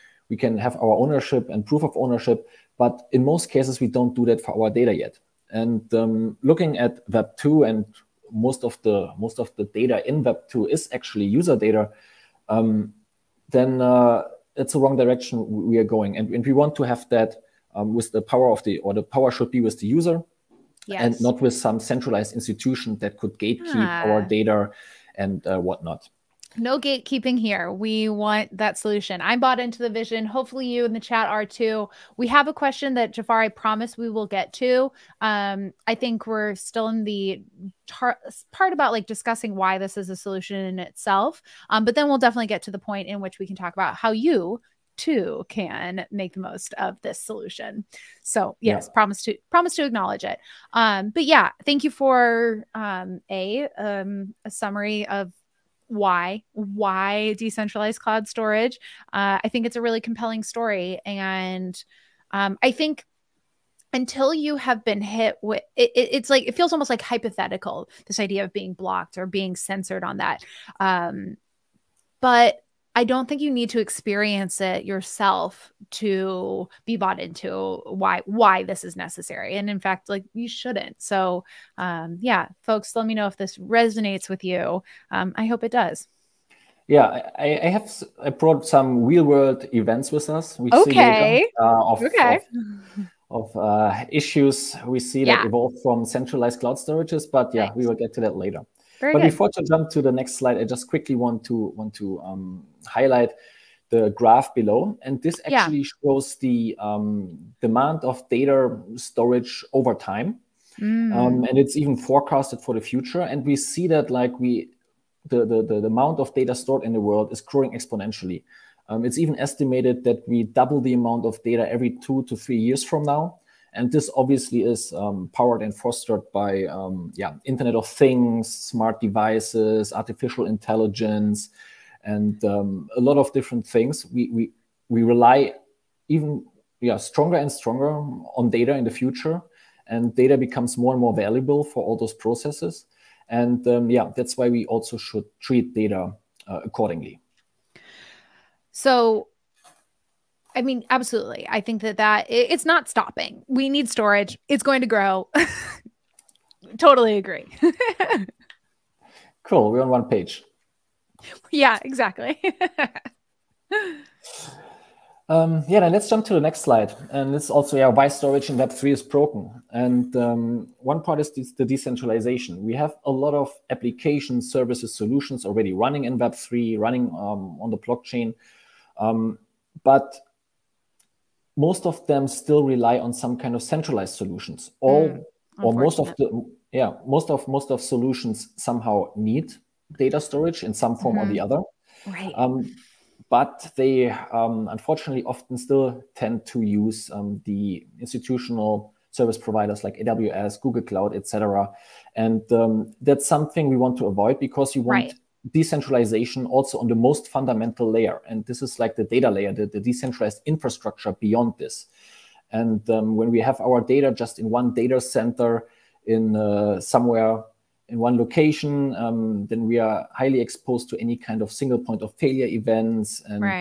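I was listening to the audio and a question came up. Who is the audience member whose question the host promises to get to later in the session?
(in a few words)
Jafar.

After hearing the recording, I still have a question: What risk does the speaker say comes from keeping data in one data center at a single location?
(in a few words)
single point of failure.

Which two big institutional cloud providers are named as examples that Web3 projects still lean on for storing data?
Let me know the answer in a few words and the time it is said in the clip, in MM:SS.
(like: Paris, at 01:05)
AWS, Google Cloud, at 03:19.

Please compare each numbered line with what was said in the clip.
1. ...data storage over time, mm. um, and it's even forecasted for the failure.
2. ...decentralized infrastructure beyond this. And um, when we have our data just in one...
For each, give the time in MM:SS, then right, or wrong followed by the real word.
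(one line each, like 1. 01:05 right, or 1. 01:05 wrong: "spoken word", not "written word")
1. 01:48 wrong: "future", not "failure"
2. 03:29 right.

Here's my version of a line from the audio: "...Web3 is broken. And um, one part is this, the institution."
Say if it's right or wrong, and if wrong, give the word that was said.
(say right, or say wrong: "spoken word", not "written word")
wrong: "decentralization", not "institution".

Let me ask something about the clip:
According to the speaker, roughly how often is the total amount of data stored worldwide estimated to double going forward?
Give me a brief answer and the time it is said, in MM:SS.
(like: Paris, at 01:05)
every 2 to 3 years, at 02:01.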